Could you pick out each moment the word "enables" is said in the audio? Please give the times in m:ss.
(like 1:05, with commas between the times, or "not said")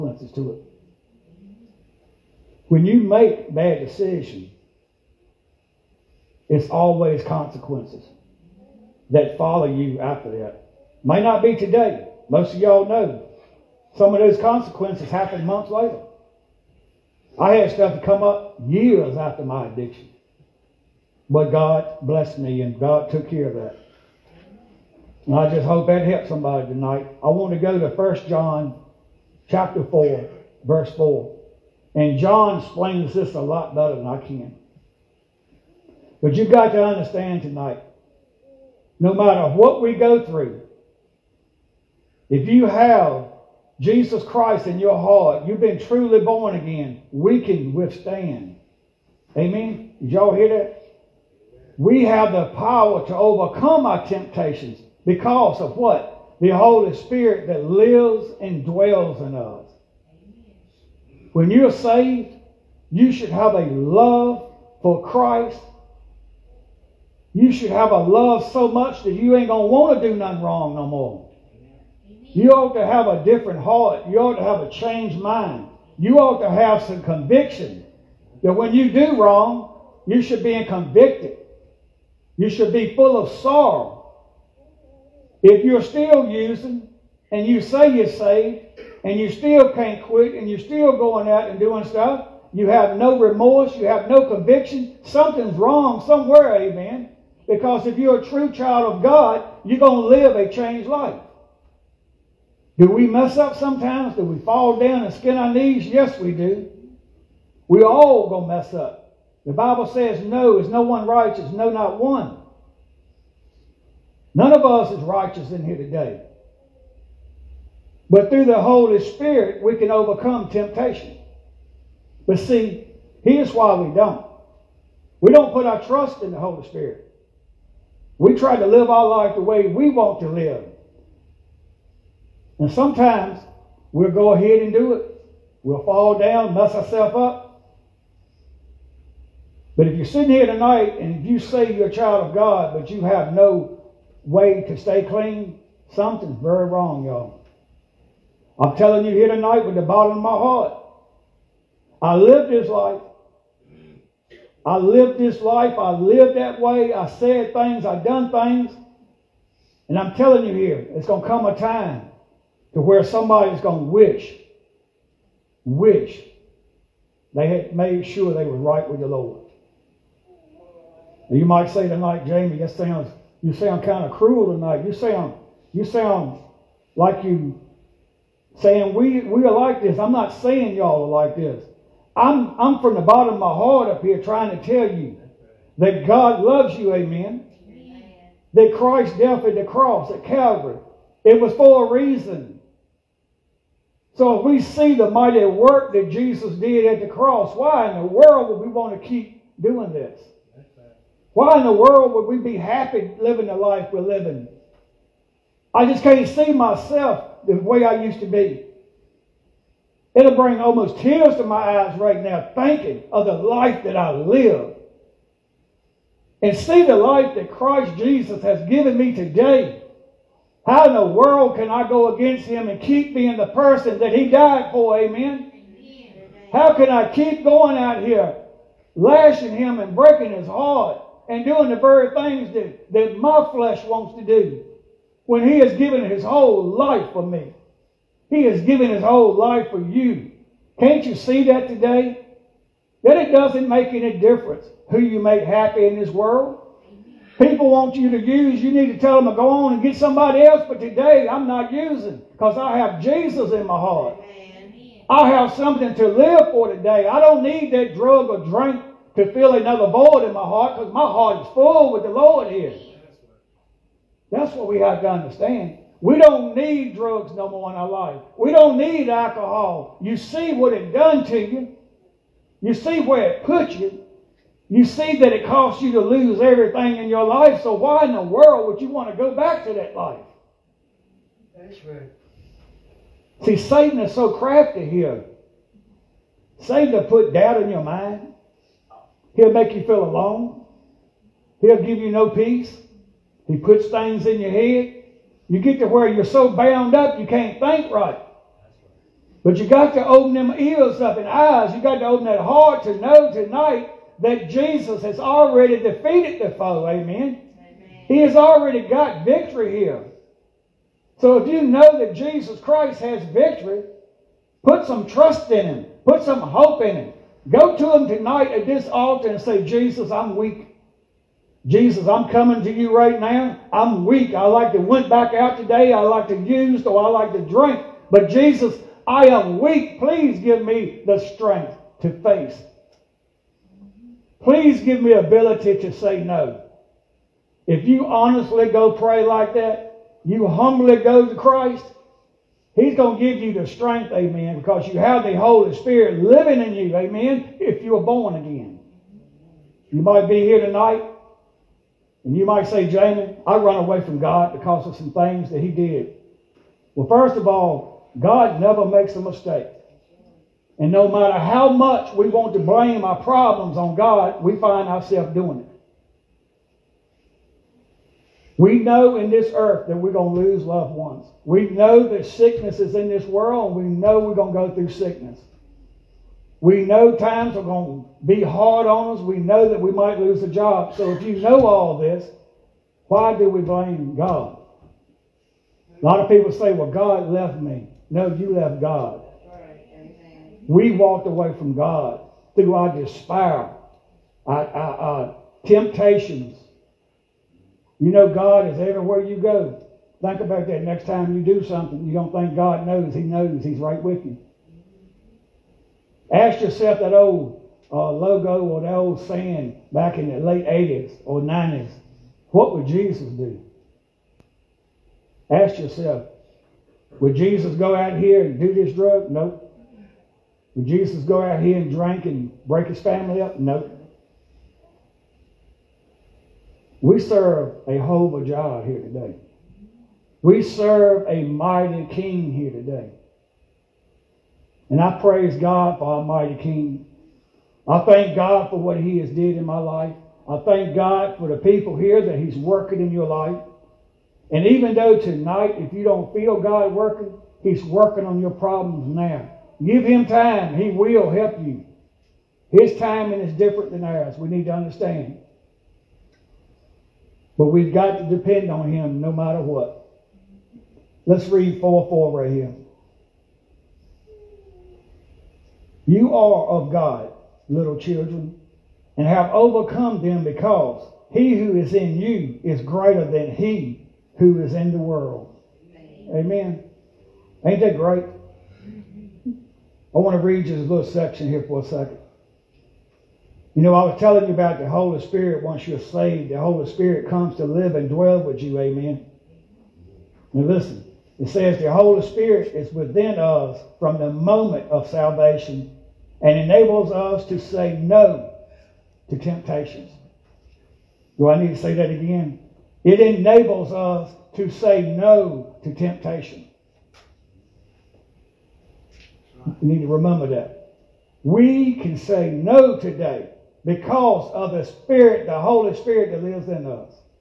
8:16, 8:23.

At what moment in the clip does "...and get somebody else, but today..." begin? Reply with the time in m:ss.
4:09.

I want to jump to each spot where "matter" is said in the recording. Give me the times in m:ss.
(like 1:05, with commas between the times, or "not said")
0:39, 6:01, 7:39.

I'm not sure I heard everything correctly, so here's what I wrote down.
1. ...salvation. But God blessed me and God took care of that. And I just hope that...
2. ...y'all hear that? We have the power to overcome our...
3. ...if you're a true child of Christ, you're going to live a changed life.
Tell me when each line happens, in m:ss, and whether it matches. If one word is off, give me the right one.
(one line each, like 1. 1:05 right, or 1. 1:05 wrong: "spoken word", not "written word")
1. 0:19 wrong: "addiction", not "salvation"
2. 0:50 right
3. 1:37 wrong: "God", not "Christ".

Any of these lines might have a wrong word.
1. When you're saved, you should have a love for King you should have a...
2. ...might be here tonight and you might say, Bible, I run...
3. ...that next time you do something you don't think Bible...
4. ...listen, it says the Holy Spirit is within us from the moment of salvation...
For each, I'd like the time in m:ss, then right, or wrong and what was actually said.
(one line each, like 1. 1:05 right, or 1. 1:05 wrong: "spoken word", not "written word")
1. 1:01 wrong: "Christ", not "King"
2. 5:50 wrong: "Jamie", not "Bible"
3. 6:40 wrong: "God", not "Bible"
4. 8:10 right.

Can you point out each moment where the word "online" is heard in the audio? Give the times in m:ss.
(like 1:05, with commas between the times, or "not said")
not said.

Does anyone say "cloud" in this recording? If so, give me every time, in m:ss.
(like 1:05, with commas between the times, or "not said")
not said.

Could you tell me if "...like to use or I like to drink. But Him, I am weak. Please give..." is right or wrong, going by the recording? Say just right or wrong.
wrong.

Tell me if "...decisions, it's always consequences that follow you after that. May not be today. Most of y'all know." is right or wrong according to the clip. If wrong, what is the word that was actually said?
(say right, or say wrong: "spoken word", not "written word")
right.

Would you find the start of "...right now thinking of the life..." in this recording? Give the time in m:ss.
3:31.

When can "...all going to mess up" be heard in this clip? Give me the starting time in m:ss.
1:47.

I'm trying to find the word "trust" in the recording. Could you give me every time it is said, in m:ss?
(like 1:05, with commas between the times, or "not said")
2:05, 5:15.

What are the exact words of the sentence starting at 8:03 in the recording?
You know, I was telling you about the Holy Spirit once you're saved.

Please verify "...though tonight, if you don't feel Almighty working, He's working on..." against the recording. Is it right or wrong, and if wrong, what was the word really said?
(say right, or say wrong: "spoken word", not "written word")
wrong: "God", not "Almighty".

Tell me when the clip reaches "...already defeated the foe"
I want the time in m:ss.
5:05.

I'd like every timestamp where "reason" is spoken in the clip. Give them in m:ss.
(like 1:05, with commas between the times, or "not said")
3:11.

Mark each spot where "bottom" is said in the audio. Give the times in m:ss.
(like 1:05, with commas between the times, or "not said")
2:29, 3:03.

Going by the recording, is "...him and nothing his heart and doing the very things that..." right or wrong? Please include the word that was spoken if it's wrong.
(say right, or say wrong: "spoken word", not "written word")
wrong: "breaking", not "nothing".